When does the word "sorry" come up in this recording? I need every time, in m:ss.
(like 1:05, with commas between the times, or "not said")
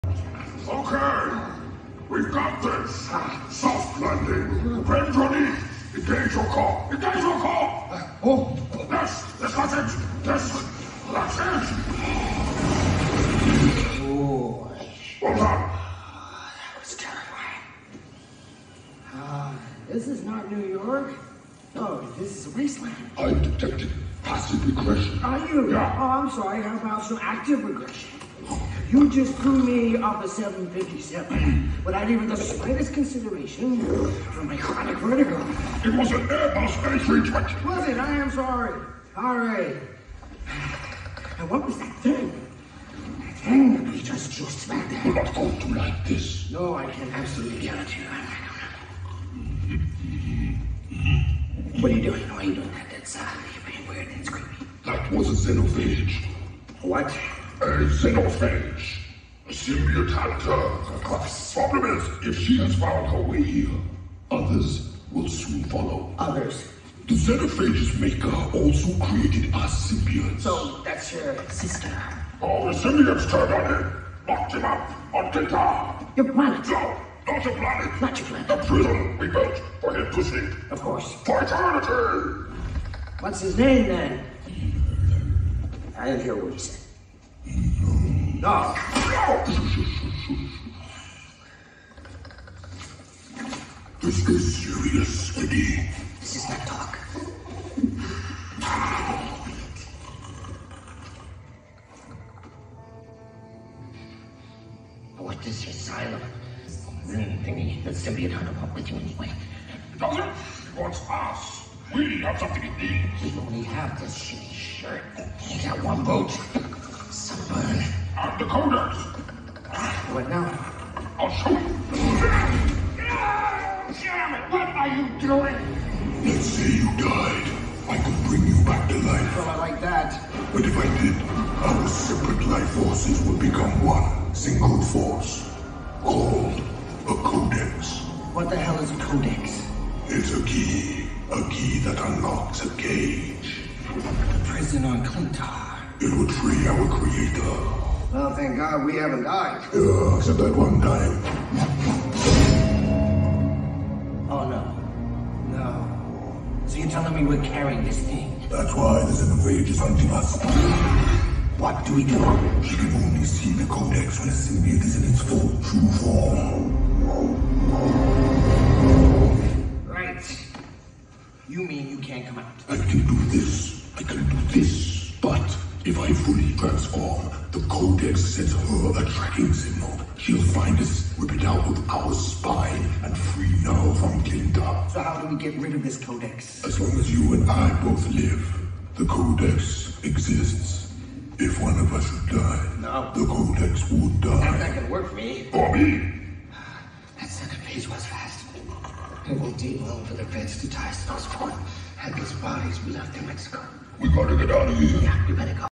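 0:26, 0:38.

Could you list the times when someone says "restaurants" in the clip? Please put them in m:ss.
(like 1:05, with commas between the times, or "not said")
not said.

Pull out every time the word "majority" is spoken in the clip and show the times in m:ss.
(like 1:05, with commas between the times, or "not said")
not said.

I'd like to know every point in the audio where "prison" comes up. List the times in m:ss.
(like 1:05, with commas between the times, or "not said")
1:18, 2:24.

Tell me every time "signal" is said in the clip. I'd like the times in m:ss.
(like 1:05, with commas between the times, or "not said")
2:59.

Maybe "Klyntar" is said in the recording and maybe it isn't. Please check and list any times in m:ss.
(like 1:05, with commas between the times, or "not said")
1:15, 2:25, 3:04.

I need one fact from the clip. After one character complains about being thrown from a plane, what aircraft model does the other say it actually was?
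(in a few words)
Airbus A320.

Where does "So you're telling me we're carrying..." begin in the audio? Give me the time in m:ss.
2:36.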